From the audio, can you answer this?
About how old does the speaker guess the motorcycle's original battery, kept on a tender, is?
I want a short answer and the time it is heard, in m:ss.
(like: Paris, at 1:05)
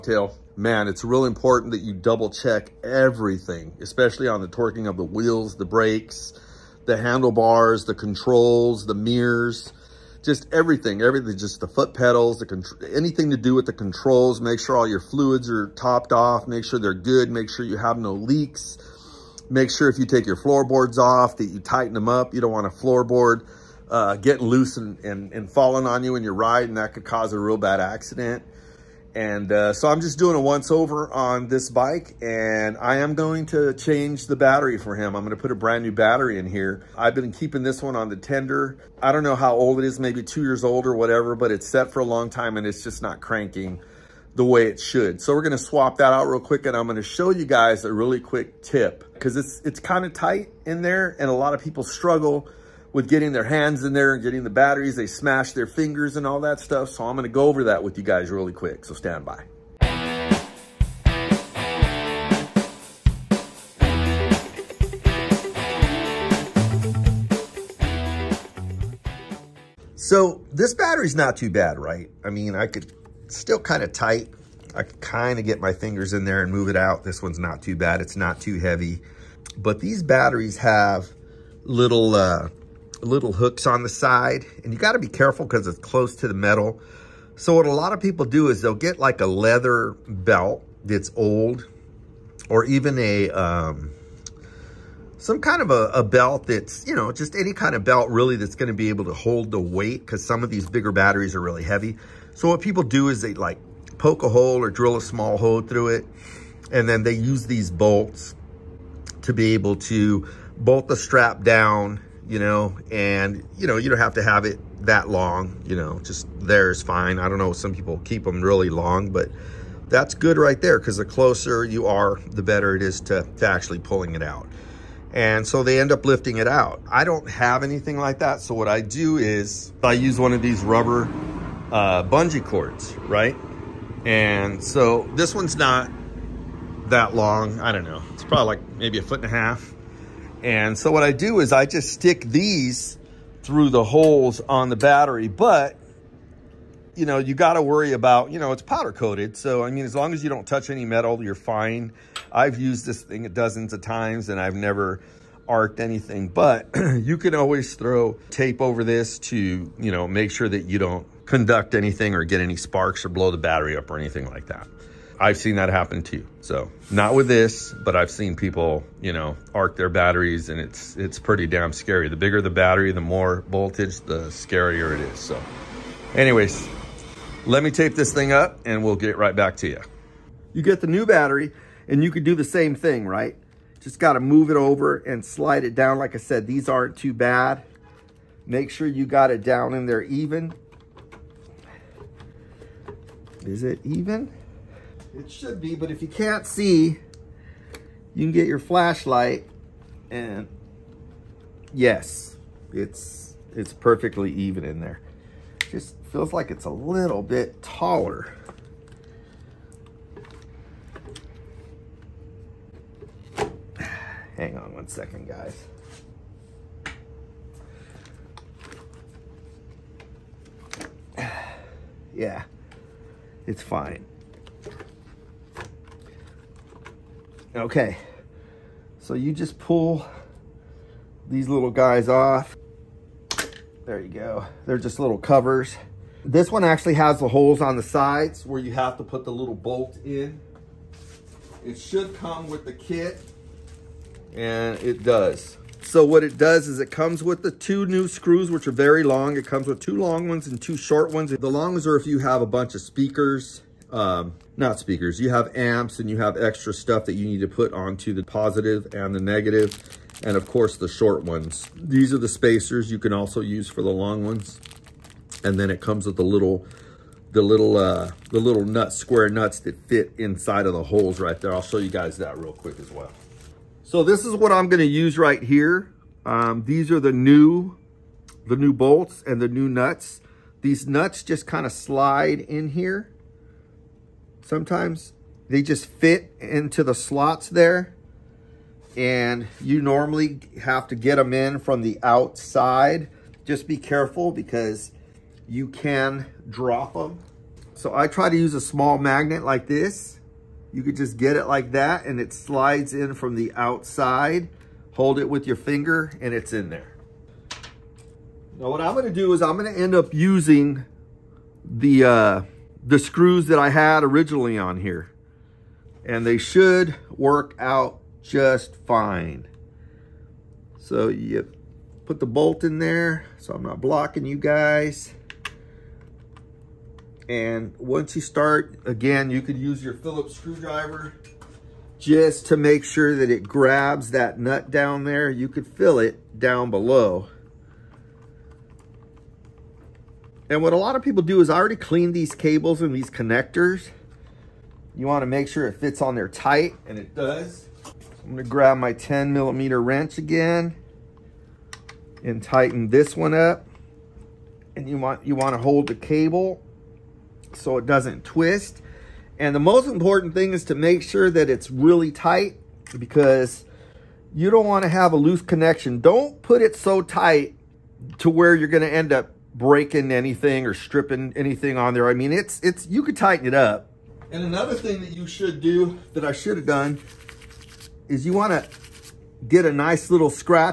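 2 years, at 0:40.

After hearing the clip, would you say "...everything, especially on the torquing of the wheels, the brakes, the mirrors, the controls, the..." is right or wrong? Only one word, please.
wrong.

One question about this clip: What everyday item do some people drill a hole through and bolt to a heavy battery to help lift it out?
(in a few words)
Leather belt.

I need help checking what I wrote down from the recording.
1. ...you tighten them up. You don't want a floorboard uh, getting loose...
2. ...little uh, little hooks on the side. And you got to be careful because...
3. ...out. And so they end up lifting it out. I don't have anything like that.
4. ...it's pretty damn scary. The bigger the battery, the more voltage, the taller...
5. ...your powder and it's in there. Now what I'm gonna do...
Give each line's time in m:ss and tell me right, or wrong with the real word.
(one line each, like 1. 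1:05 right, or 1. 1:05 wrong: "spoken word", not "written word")
1. 0:21 right
2. 1:21 right
3. 2:04 right
4. 2:50 wrong: "scarier", not "taller"
5. 5:05 wrong: "finger", not "powder".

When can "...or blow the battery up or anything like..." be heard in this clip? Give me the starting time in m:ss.
2:43.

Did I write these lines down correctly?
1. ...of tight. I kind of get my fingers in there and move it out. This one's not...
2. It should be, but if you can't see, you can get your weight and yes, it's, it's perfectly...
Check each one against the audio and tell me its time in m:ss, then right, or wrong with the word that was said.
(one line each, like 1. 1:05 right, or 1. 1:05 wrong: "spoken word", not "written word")
1. 1:13 right
2. 3:15 wrong: "flashlight", not "weight".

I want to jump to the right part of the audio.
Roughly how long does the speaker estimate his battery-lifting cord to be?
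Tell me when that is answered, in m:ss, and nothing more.
2:18.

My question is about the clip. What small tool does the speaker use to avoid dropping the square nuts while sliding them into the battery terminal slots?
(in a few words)
Small magnet.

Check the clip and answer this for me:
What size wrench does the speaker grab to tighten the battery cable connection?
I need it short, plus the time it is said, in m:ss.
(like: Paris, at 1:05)
10 millimeter, at 5:48.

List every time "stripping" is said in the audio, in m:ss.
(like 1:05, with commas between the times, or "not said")
6:10.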